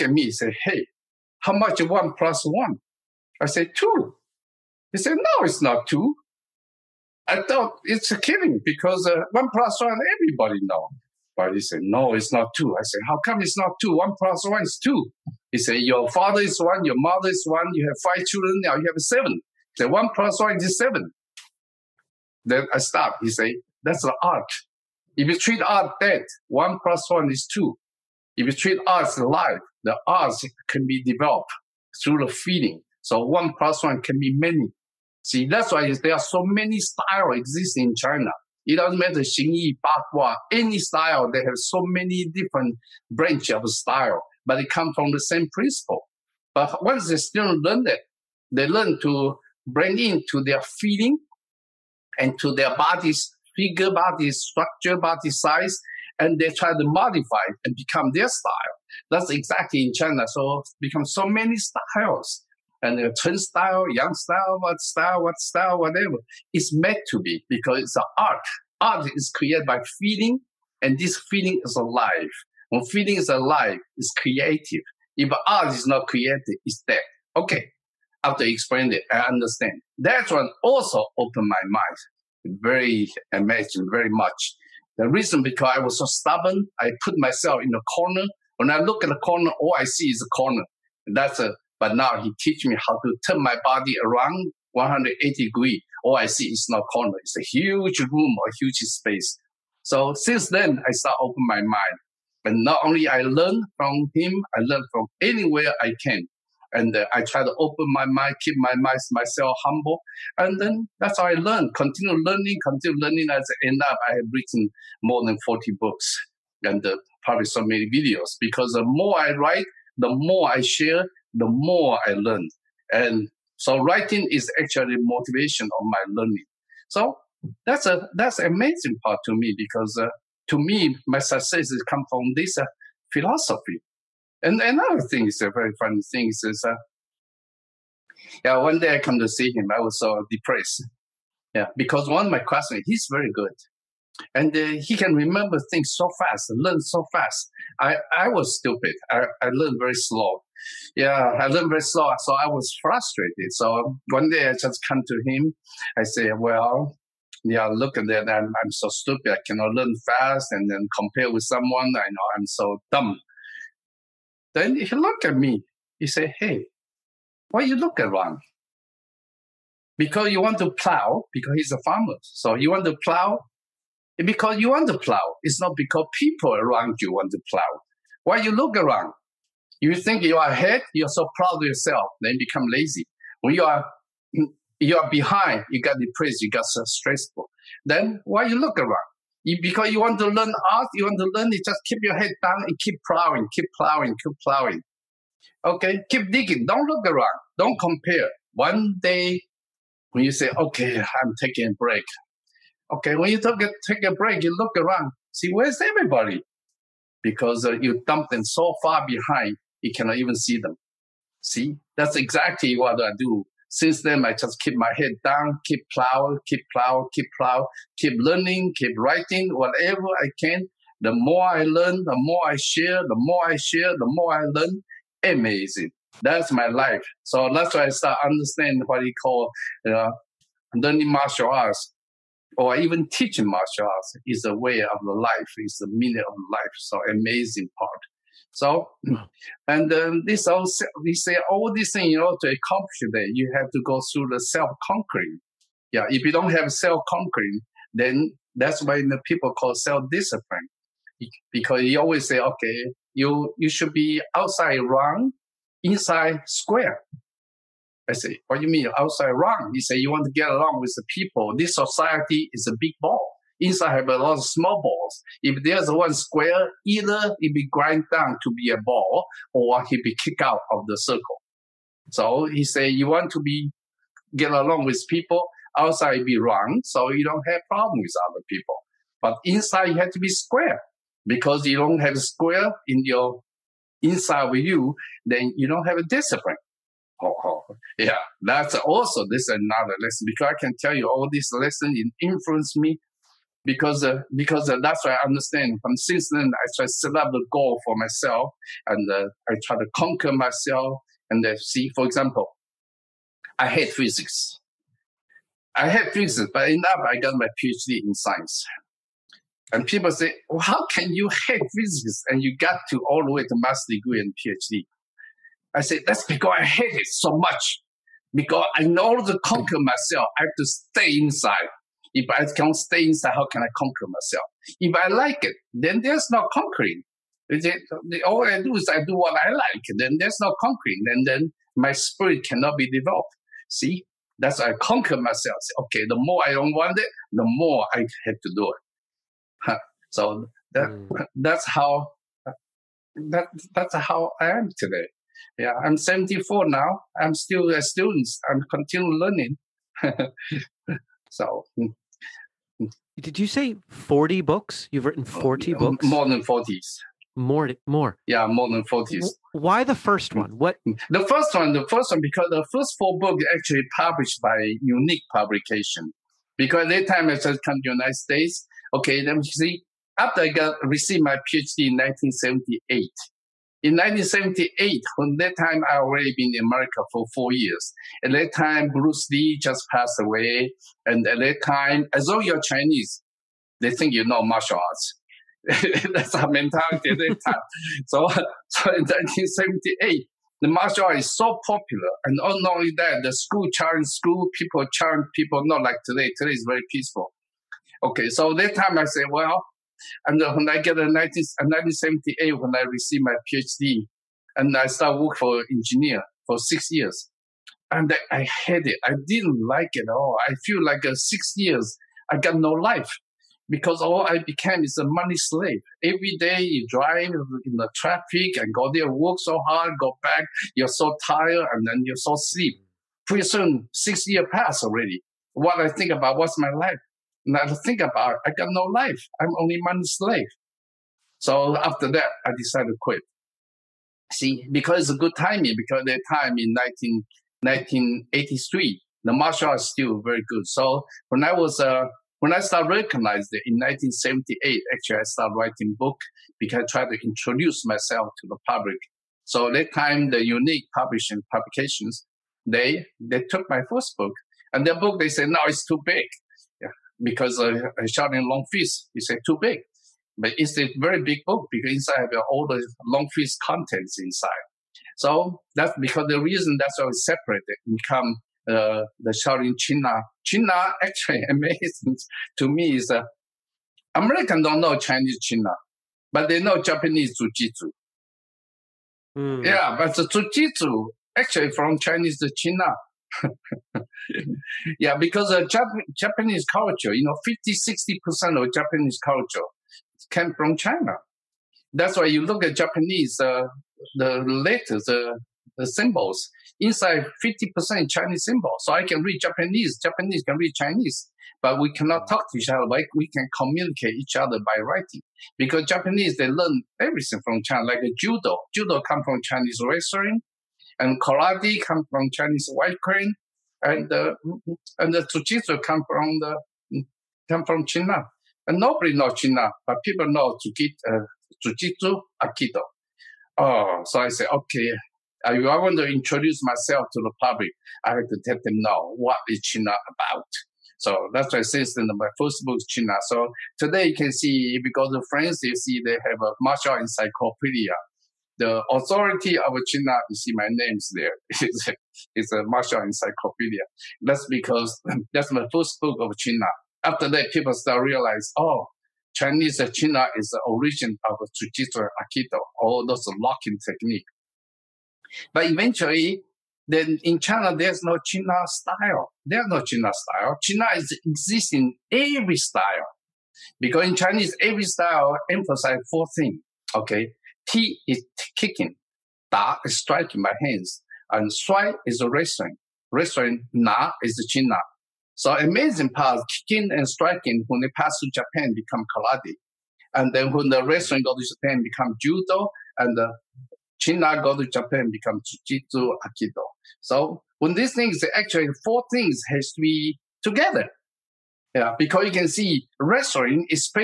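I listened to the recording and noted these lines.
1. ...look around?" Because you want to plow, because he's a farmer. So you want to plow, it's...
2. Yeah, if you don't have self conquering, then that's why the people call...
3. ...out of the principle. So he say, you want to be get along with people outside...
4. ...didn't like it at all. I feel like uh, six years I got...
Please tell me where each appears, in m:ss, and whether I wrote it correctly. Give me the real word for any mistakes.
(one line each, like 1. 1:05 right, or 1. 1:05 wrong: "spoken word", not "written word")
1. 2:47 right
2. 4:05 right
3. 4:30 wrong: "circle", not "principle"
4. 6:49 right.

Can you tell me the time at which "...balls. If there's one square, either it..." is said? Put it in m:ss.
4:24.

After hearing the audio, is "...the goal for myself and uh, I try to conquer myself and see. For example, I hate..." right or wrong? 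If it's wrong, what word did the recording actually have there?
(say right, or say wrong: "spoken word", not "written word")
right.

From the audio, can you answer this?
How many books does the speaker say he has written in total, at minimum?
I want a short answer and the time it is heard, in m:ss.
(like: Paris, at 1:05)
more than 40, at 1:55.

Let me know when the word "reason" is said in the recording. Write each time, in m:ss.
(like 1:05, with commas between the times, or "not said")
1:25, 7:46.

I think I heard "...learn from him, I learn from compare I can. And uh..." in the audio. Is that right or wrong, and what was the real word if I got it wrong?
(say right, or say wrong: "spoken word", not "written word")
wrong: "anywhere", not "compare".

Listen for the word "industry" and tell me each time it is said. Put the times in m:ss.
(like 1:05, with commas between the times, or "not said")
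not said.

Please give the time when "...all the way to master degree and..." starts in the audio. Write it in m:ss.
5:13.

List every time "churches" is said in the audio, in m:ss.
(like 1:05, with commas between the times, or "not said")
not said.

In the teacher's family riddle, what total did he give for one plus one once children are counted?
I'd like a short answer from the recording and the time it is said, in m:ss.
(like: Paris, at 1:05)
7, at 0:19.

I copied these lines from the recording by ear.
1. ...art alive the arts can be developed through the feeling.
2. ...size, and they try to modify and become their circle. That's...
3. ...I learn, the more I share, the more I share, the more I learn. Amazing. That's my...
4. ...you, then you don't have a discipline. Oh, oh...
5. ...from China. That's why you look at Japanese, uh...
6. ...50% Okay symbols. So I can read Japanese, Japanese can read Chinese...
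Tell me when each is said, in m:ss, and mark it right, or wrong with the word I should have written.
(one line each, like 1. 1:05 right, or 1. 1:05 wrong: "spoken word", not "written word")
1. 0:28 right
2. 0:55 wrong: "style", not "circle"
3. 3:41 right
4. 4:44 right
5. 8:10 right
6. 8:17 wrong: "Chinese", not "Okay".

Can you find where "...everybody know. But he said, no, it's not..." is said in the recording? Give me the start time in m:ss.
0:10.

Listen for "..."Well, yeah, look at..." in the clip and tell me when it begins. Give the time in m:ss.
2:36.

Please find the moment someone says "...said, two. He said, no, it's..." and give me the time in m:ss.
0:03.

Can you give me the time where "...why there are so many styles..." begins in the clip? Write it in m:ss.
0:35.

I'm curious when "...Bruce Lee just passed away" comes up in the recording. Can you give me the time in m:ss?
6:18.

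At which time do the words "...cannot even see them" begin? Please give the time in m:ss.
3:29.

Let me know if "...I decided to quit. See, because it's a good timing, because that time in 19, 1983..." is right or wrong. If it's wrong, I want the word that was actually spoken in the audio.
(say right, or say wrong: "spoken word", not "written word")
right.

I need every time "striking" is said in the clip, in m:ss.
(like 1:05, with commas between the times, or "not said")
9:29, 9:37.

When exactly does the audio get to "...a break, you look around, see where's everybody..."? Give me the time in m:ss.
3:24.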